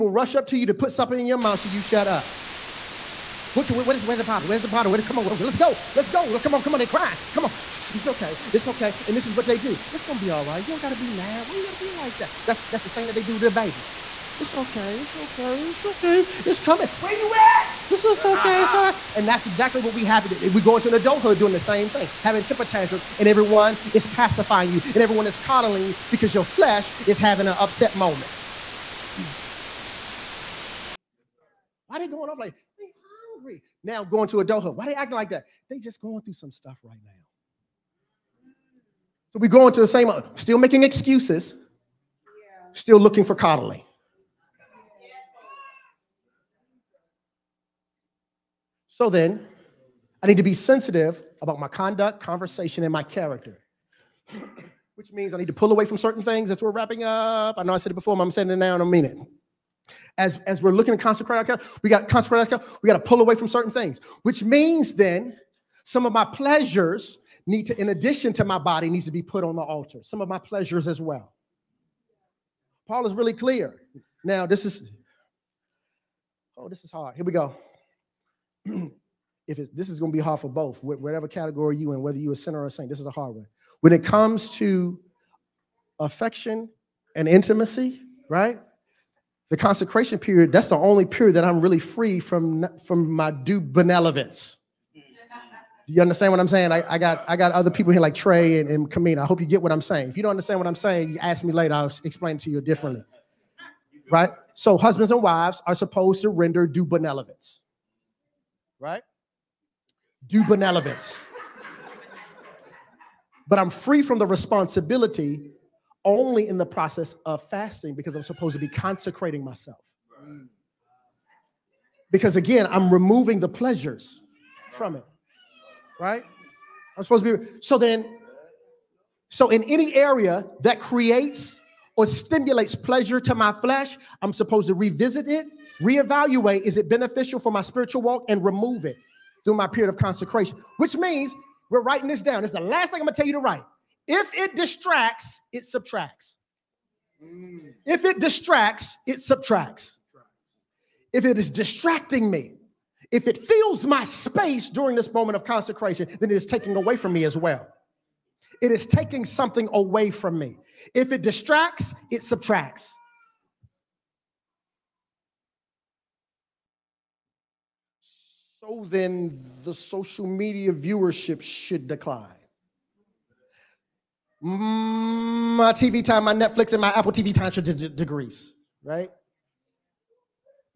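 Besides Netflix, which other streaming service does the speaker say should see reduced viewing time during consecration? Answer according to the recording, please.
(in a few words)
Apple TV.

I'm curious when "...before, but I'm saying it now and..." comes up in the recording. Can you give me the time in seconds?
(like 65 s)
57 s.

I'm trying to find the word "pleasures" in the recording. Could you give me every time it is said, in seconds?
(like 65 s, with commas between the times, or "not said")
66 s, 70 s, 123 s, 132 s.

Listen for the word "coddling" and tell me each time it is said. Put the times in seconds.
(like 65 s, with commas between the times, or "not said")
25 s, 43 s.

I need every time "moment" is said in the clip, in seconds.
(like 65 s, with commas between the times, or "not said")
27 s, 155 s.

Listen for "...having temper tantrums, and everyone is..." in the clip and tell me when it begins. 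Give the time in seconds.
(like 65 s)
22 s.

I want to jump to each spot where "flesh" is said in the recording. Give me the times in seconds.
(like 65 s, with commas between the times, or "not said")
26 s, 133 s.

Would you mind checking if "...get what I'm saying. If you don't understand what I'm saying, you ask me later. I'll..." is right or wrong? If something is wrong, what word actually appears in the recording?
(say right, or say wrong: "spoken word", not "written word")
right.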